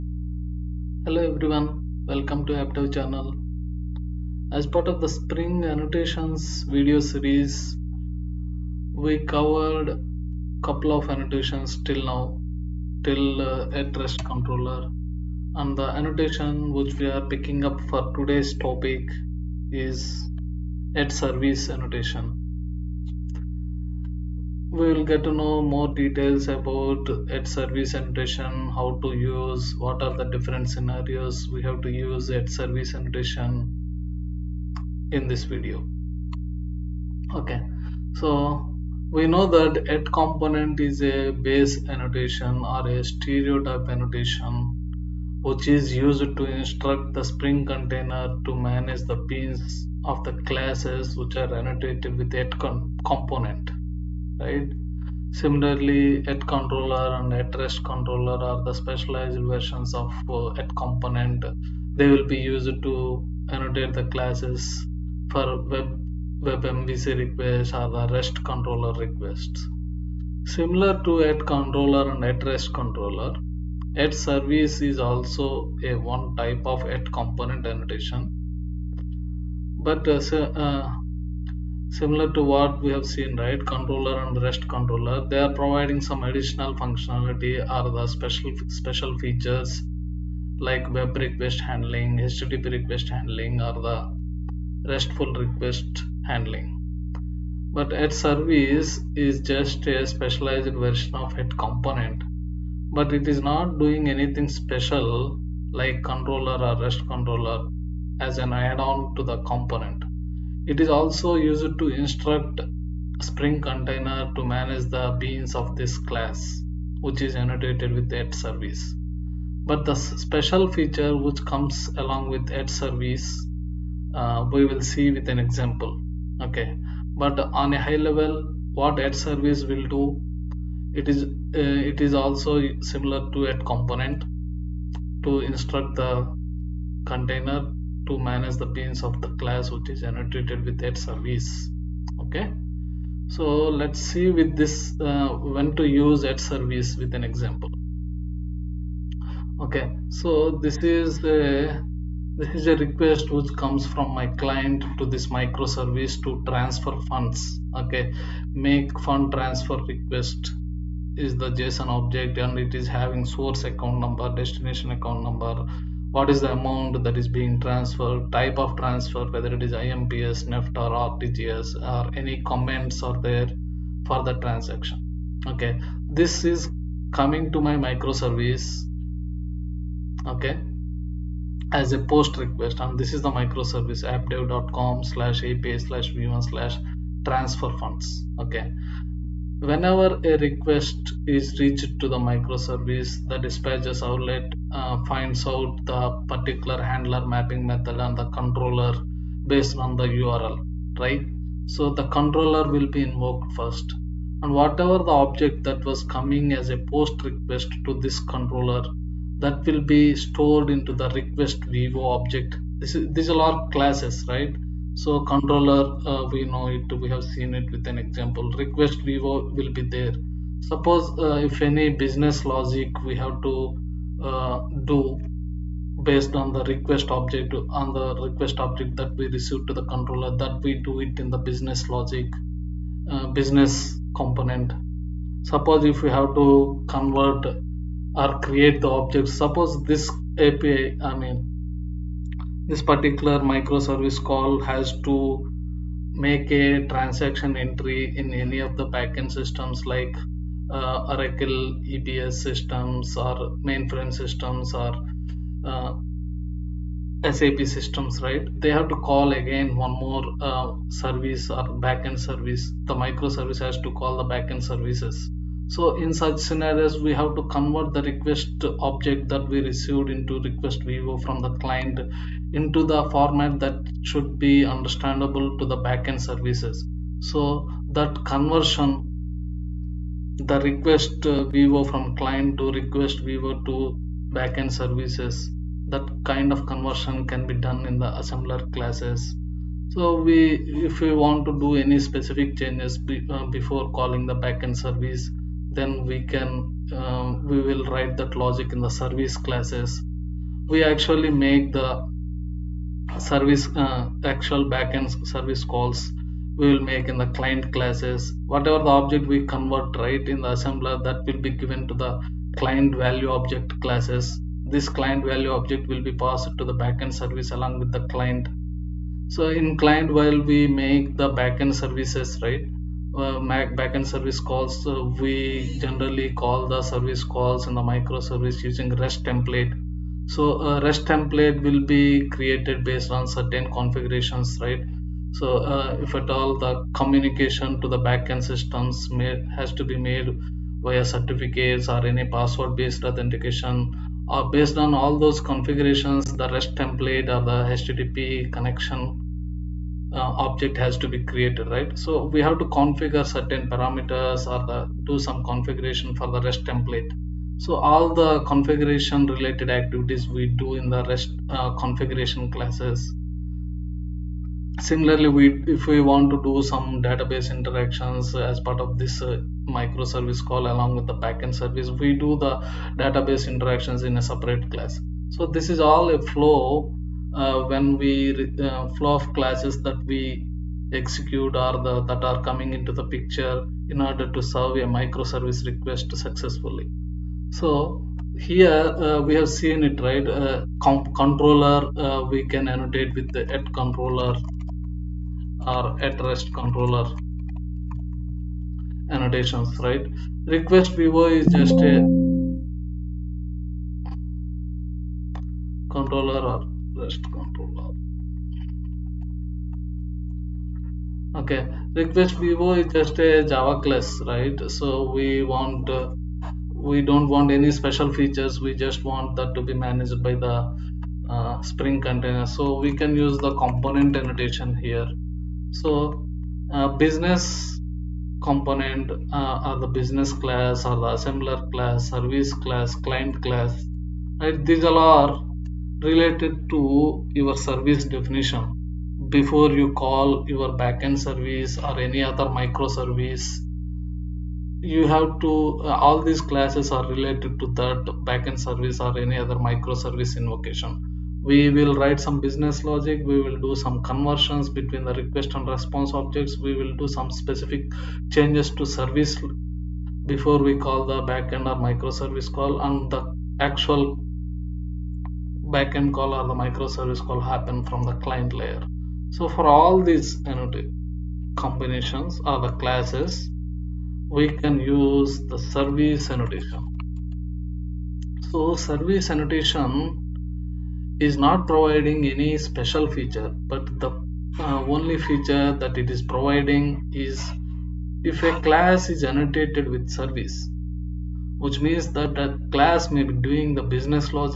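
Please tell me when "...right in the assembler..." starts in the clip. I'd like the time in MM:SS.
05:10.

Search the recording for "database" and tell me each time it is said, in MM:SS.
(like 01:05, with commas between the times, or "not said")
06:07, 06:12.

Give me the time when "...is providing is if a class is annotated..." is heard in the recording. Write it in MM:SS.
08:06.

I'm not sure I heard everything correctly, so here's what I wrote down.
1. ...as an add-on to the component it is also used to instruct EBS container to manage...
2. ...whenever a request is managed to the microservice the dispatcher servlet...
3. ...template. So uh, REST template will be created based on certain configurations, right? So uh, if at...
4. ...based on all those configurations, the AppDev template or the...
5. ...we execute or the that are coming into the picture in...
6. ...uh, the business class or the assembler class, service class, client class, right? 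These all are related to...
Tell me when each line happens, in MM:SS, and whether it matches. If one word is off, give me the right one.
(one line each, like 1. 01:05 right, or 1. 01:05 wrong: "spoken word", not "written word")
1. 01:48 wrong: "Spring", not "EBS"
2. 03:09 wrong: "reached", not "managed"
3. 05:29 right
4. 05:44 wrong: "REST", not "AppDev"
5. 06:20 right
6. 07:09 right.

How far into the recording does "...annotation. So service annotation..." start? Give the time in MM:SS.
07:56.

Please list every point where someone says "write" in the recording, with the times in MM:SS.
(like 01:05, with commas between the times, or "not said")
04:57, 07:31.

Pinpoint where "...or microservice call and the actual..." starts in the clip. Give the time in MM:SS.
07:41.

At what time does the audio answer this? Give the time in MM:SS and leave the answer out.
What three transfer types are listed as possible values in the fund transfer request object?
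02:49.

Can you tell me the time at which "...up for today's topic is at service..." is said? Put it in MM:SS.
00:17.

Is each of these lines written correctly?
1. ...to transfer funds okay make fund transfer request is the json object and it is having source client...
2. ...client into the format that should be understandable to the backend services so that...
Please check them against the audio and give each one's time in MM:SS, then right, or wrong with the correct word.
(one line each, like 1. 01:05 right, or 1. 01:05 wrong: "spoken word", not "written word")
1. 02:36 wrong: "account", not "client"
2. 04:31 right.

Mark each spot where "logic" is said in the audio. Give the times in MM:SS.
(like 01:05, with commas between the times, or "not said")
03:42, 03:51, 04:58, 07:32.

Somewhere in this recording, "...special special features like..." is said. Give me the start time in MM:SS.
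01:28.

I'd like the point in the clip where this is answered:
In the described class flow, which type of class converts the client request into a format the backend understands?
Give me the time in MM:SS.
04:48.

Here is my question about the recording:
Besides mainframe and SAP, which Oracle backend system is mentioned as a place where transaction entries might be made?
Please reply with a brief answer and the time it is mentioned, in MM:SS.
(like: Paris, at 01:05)
Oracle EBS, at 04:11.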